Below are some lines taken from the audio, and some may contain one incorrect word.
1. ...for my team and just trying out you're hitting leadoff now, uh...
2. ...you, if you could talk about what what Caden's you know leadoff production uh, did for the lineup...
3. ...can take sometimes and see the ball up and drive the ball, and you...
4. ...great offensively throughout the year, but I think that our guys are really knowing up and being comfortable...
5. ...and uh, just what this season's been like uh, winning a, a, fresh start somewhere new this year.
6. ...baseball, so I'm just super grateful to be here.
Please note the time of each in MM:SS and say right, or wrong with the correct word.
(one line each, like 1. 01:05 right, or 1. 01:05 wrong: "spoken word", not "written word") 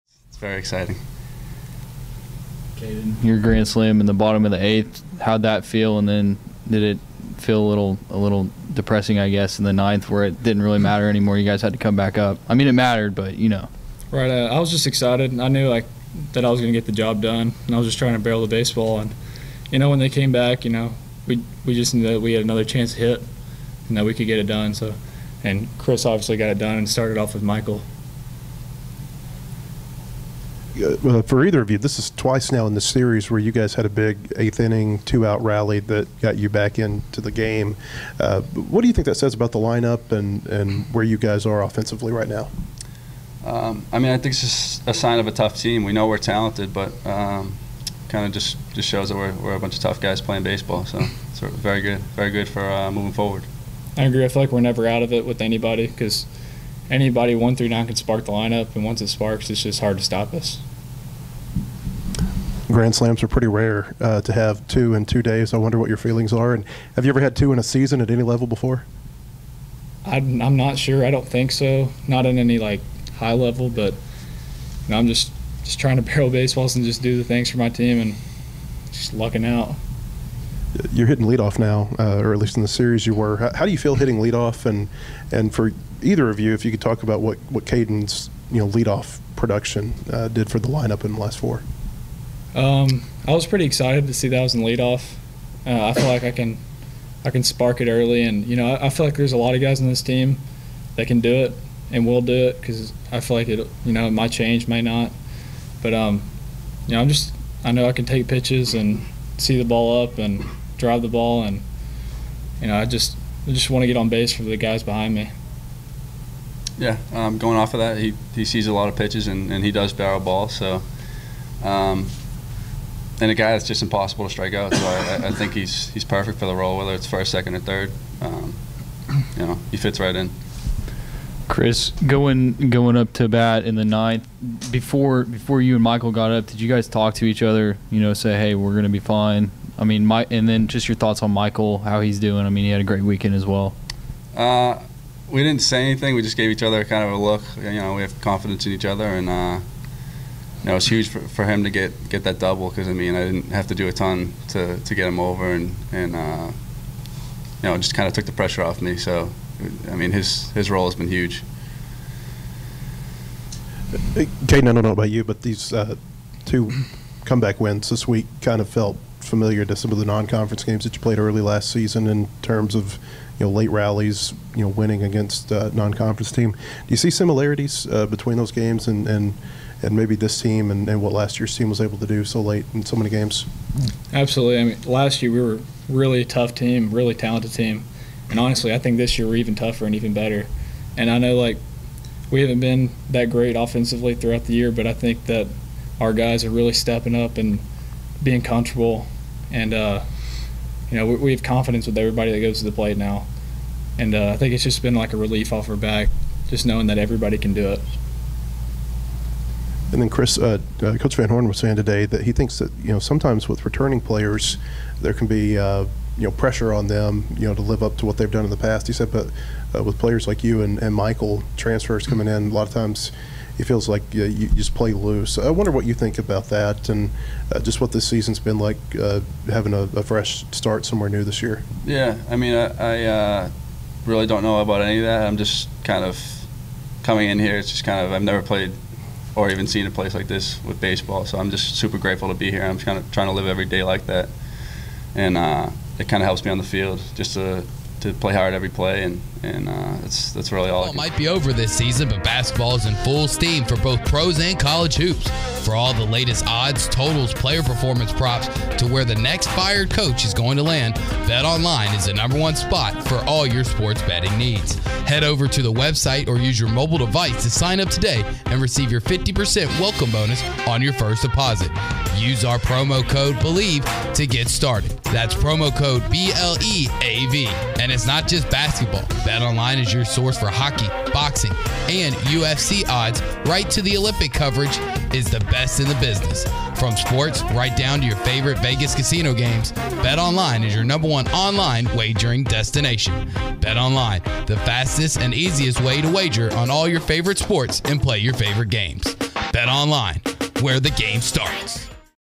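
1. 01:17 wrong: "lucking", not "trying"
2. 01:26 right
3. 01:47 wrong: "pitches", not "sometimes"
4. 03:13 wrong: "stepping", not "knowing"
5. 03:46 wrong: "having", not "winning"
6. 04:00 right.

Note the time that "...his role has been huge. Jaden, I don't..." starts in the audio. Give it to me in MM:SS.
02:40.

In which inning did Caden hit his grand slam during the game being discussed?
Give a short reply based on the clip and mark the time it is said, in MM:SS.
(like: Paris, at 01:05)
Bottom of the eighth, at 00:04.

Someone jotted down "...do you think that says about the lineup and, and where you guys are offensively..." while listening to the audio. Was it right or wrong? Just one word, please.
right.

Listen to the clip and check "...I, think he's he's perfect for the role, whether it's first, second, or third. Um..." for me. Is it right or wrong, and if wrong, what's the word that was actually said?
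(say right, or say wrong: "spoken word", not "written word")
right.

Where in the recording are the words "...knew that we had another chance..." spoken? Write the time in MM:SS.
00:21.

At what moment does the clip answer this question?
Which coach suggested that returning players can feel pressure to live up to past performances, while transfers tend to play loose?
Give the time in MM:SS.
03:30.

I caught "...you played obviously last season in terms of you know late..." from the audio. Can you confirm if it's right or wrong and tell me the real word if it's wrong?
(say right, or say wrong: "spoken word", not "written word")
wrong: "early", not "obviously".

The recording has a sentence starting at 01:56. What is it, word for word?
Yeah, um, going off of that, he, he sees a lot of pitches and, and he does barrel ball.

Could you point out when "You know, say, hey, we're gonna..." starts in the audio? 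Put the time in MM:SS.
02:17.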